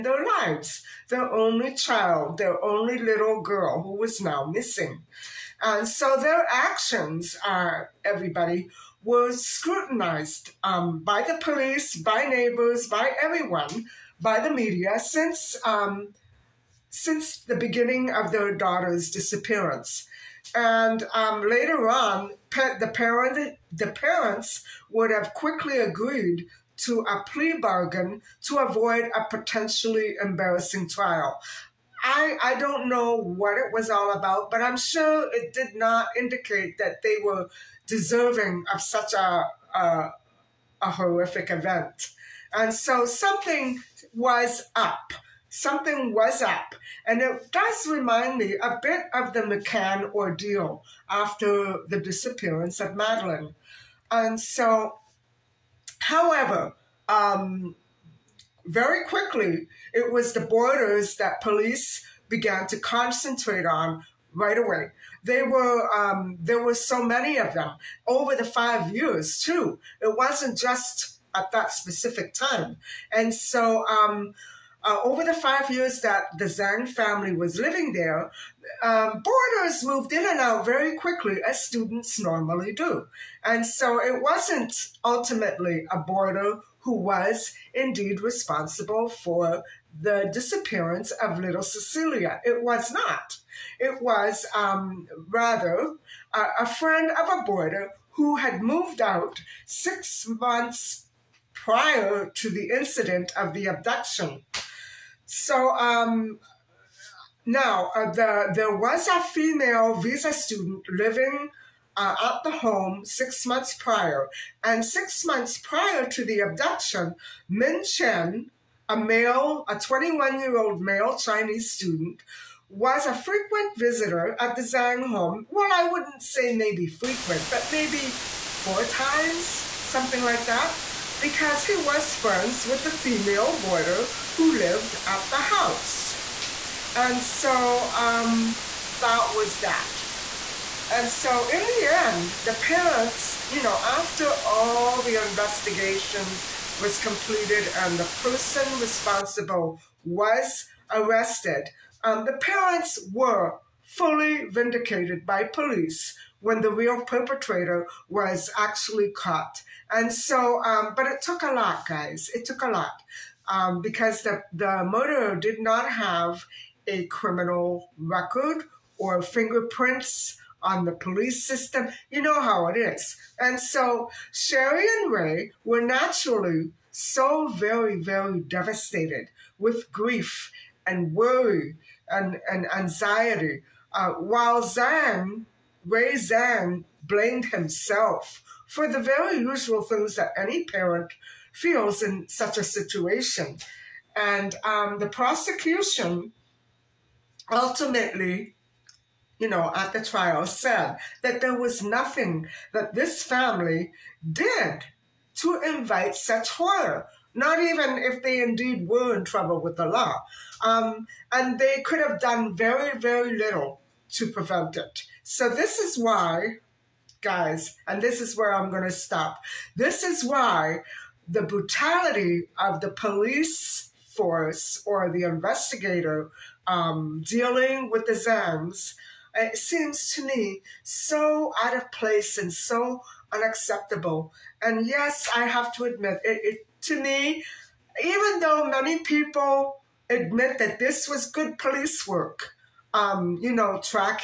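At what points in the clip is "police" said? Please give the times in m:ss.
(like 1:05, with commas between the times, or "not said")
0:11, 1:01, 2:35, 2:50, 3:42, 4:01.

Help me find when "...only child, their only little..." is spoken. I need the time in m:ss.
0:01.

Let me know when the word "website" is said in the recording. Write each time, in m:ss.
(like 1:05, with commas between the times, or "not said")
not said.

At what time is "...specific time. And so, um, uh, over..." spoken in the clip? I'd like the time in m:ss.
1:11.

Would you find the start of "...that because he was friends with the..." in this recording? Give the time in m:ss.
2:10.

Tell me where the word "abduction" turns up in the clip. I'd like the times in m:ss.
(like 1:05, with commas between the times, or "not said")
1:43, 1:56.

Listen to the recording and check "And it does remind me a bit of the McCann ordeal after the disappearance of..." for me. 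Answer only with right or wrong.
right.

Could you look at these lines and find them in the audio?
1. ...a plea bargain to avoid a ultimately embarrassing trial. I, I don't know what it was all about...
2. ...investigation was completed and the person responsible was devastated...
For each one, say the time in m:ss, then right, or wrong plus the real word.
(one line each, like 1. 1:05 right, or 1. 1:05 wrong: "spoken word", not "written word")
1. 0:27 wrong: "potentially", not "ultimately"
2. 2:25 wrong: "arrested", not "devastated".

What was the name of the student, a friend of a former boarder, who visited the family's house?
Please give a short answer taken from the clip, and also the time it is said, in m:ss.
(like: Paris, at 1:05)
Min Chen, at 1:57.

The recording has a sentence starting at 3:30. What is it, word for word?
Um, and they could have done very, very little to prevent it.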